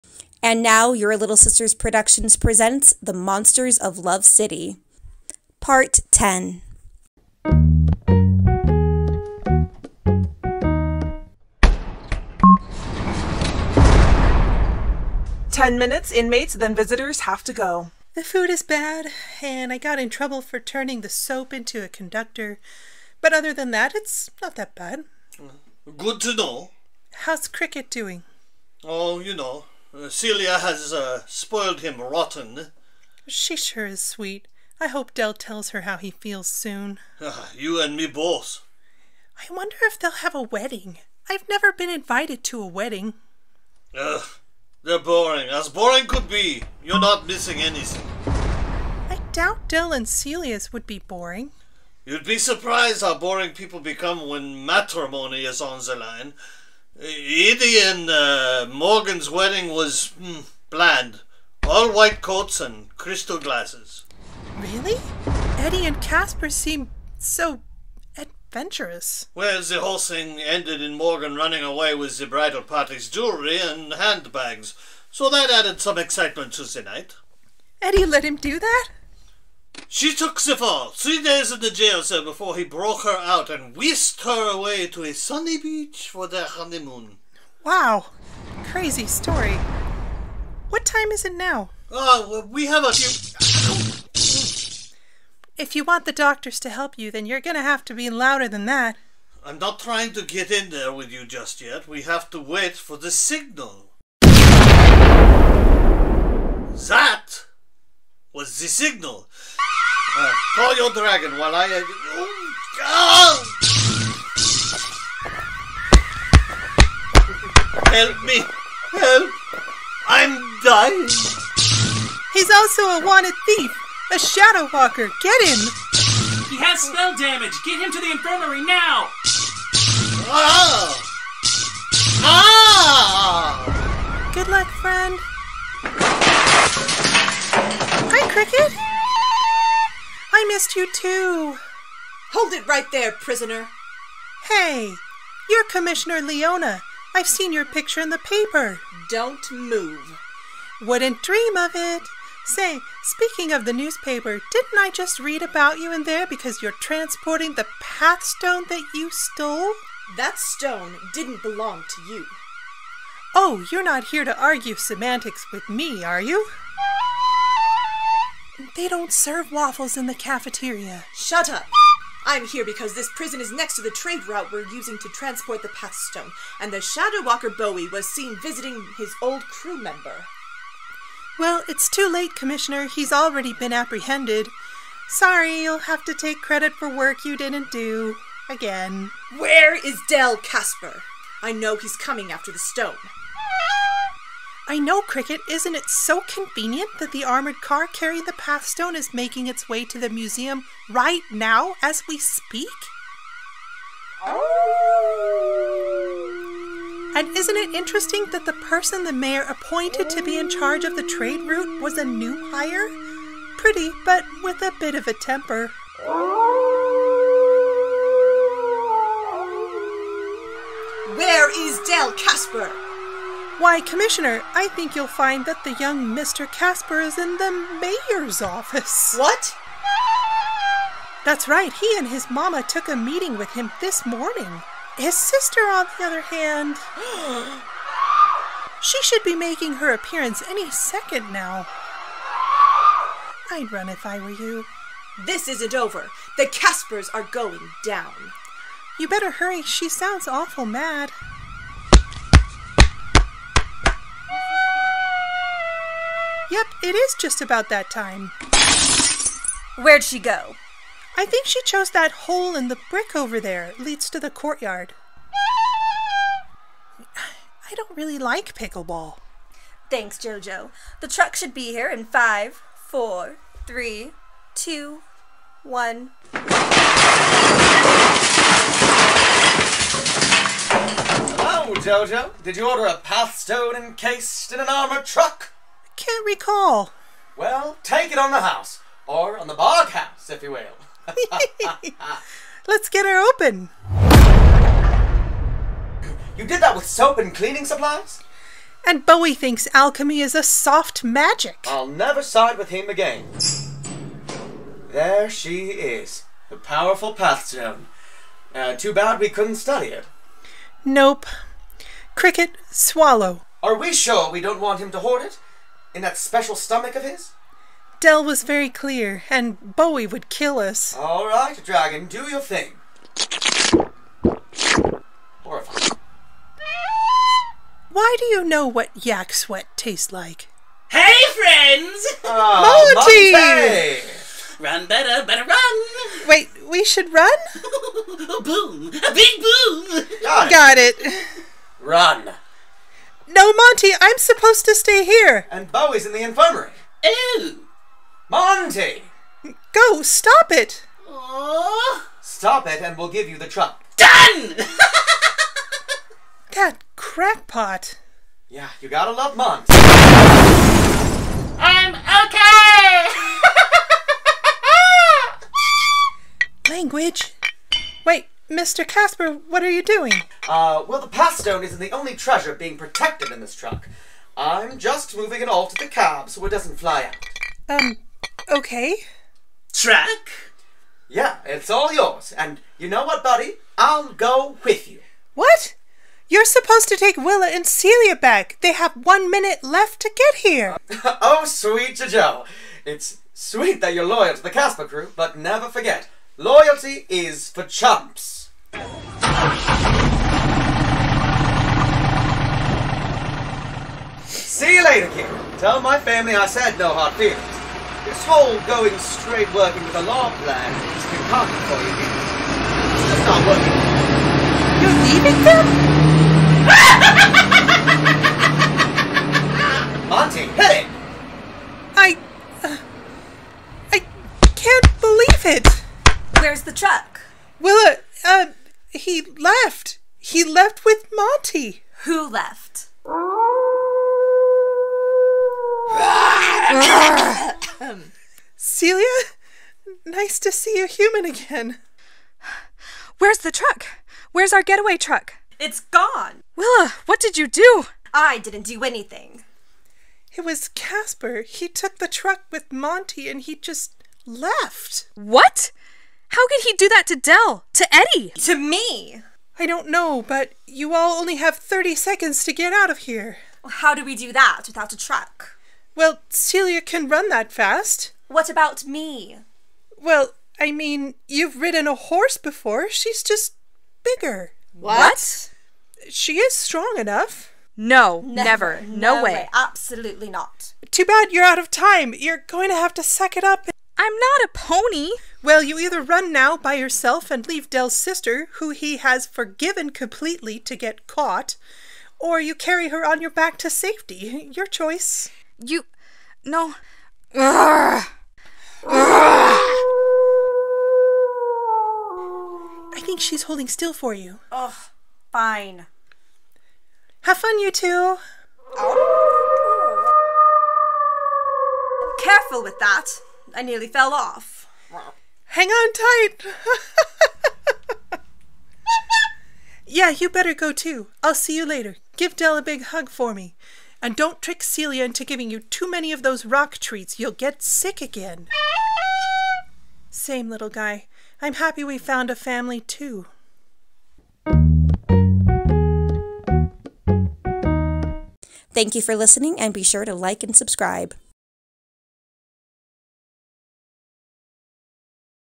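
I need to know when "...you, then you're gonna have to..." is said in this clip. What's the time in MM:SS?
01:36.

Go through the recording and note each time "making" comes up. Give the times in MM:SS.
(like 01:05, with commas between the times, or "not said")
03:19, 03:59.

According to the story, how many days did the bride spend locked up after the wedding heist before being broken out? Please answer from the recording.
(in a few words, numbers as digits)
3.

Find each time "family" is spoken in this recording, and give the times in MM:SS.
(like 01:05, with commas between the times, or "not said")
06:45, 08:52.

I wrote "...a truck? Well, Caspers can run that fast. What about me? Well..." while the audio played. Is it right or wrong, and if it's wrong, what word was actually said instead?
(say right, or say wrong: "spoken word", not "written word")
wrong: "Celia", not "Caspers".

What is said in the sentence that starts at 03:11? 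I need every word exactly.
I know he's coming after the stone.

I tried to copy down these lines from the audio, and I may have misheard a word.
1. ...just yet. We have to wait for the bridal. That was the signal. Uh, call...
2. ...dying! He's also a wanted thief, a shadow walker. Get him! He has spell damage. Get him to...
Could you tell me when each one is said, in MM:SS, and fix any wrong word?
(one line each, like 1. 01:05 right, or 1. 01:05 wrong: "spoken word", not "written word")
1. 01:41 wrong: "signal", not "bridal"
2. 02:00 right.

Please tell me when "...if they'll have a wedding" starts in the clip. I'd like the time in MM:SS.
00:39.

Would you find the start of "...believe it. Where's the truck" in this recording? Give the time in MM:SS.
07:04.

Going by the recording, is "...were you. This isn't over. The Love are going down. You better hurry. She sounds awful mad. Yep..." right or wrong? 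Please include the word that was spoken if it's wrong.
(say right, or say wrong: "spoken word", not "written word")
wrong: "Caspers", not "Love".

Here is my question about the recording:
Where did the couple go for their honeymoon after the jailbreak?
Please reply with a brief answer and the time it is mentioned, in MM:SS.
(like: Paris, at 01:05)
A sunny beach, at 01:25.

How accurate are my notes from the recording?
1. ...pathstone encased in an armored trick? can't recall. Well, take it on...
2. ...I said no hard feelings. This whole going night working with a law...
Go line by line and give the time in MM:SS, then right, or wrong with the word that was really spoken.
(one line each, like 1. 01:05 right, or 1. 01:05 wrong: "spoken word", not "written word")
1. 04:42 wrong: "truck", not "trick"
2. 06:46 wrong: "straight", not "night".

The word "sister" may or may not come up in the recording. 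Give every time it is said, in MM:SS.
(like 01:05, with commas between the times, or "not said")
00:01, 03:55, 08:07.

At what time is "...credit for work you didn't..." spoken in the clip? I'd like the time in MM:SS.
03:06.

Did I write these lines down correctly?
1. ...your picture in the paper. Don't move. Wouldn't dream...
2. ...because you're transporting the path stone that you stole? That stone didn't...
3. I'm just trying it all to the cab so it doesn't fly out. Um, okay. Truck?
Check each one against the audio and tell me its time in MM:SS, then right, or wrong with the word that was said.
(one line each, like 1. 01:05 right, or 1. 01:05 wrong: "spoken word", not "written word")
1. 02:27 right
2. 02:36 right
3. 06:14 wrong: "moving", not "trying".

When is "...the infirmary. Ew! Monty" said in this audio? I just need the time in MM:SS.
05:46.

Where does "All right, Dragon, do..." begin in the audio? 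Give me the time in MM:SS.
05:20.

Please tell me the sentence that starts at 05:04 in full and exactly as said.
There she is, the powerful path stone.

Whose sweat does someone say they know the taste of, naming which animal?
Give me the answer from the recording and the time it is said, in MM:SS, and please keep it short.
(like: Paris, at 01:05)
Yak, at 05:29.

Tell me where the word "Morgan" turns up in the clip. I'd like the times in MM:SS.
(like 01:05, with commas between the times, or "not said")
00:58, 01:10.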